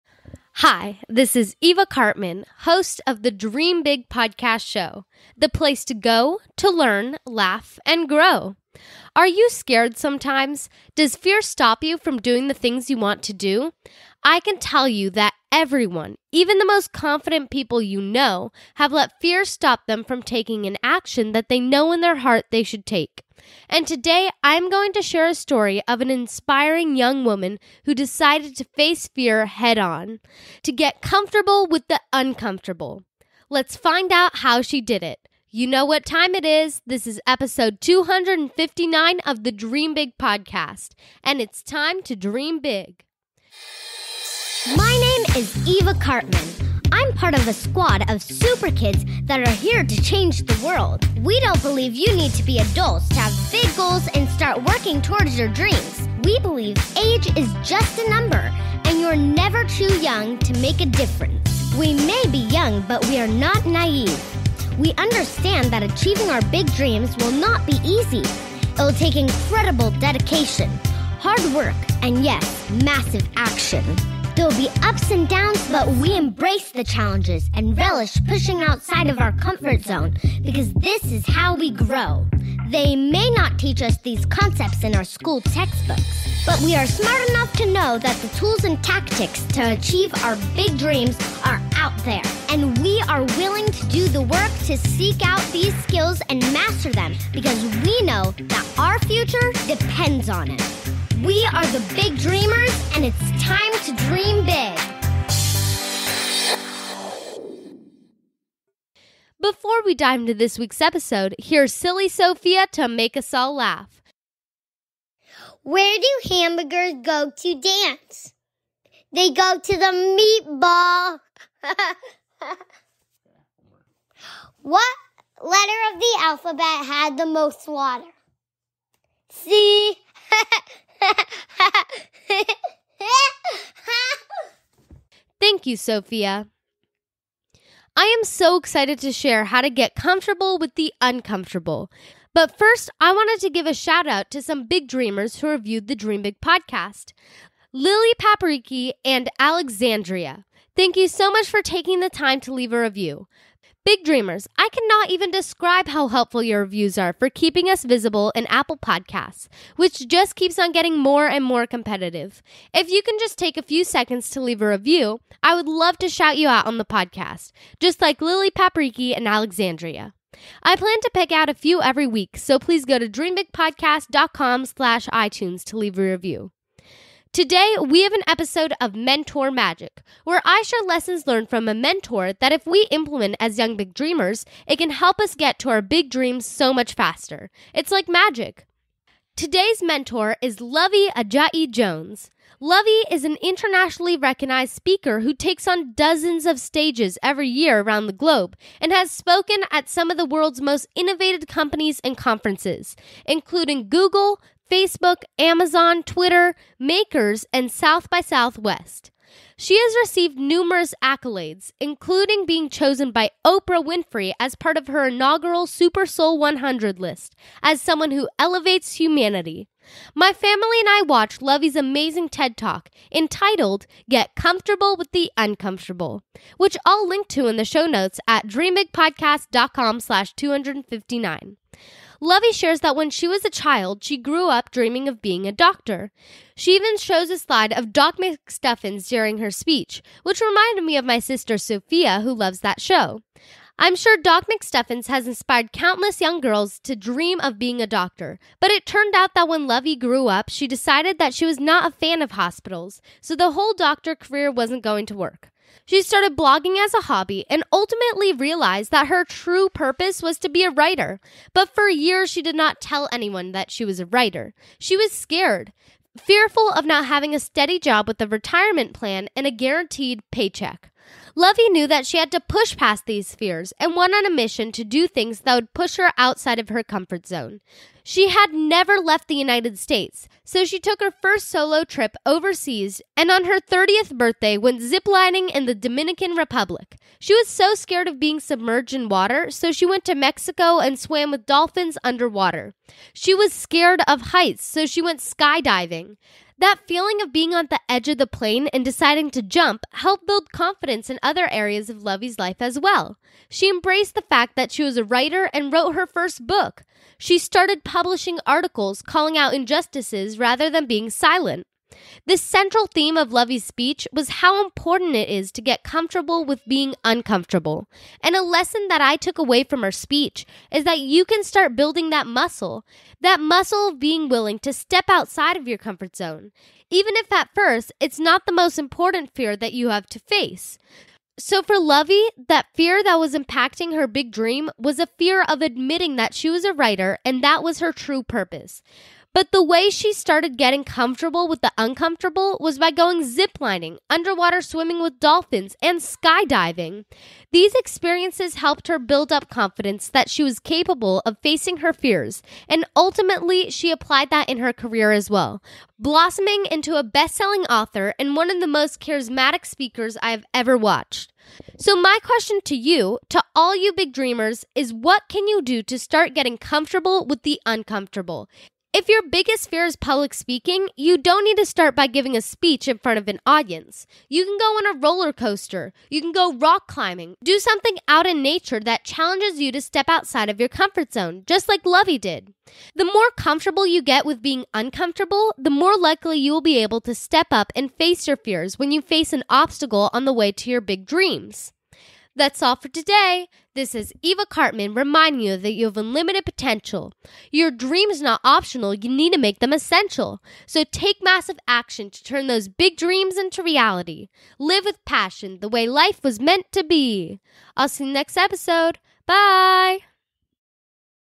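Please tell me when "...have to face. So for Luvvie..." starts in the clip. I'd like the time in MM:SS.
05:29.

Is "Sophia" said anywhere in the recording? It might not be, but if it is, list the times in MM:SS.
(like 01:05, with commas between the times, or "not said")
01:52, 02:15, 04:01.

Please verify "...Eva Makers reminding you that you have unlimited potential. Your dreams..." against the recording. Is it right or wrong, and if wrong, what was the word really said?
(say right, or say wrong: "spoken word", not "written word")
wrong: "Karpman", not "Makers".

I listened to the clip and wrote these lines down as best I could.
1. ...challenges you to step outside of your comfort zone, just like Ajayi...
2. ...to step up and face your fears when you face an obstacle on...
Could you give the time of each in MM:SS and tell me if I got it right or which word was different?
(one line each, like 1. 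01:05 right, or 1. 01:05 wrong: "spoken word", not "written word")
1. 06:19 wrong: "Luvvie", not "Ajayi"
2. 06:27 right.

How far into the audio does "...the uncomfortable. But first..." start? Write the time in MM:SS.
02:20.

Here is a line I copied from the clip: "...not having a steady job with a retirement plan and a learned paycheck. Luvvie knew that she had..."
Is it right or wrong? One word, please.
wrong.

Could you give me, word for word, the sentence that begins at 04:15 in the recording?
She started blogging as a hobby and ultimately realized that her true purpose was to be a writer.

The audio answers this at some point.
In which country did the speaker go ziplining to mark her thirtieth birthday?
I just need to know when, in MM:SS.
04:45.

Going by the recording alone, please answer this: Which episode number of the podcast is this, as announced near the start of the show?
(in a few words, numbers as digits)
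259.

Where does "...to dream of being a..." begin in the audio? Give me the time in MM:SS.
04:06.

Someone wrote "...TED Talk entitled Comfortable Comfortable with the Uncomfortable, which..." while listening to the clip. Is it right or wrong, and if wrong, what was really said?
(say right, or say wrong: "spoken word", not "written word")
wrong: "Get", not "Comfortable".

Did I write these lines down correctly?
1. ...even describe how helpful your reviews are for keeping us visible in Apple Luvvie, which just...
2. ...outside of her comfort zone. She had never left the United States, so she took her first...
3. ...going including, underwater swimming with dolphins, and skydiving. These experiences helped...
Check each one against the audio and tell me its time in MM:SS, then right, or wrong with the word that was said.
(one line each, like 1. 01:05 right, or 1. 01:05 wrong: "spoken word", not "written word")
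1. 02:35 wrong: "Podcasts", not "Luvvie"
2. 04:36 right
3. 05:42 wrong: "ziplining", not "including".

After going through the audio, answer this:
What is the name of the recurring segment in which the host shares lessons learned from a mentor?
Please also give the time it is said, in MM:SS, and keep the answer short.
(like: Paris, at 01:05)
Mentor Magic, at 02:58.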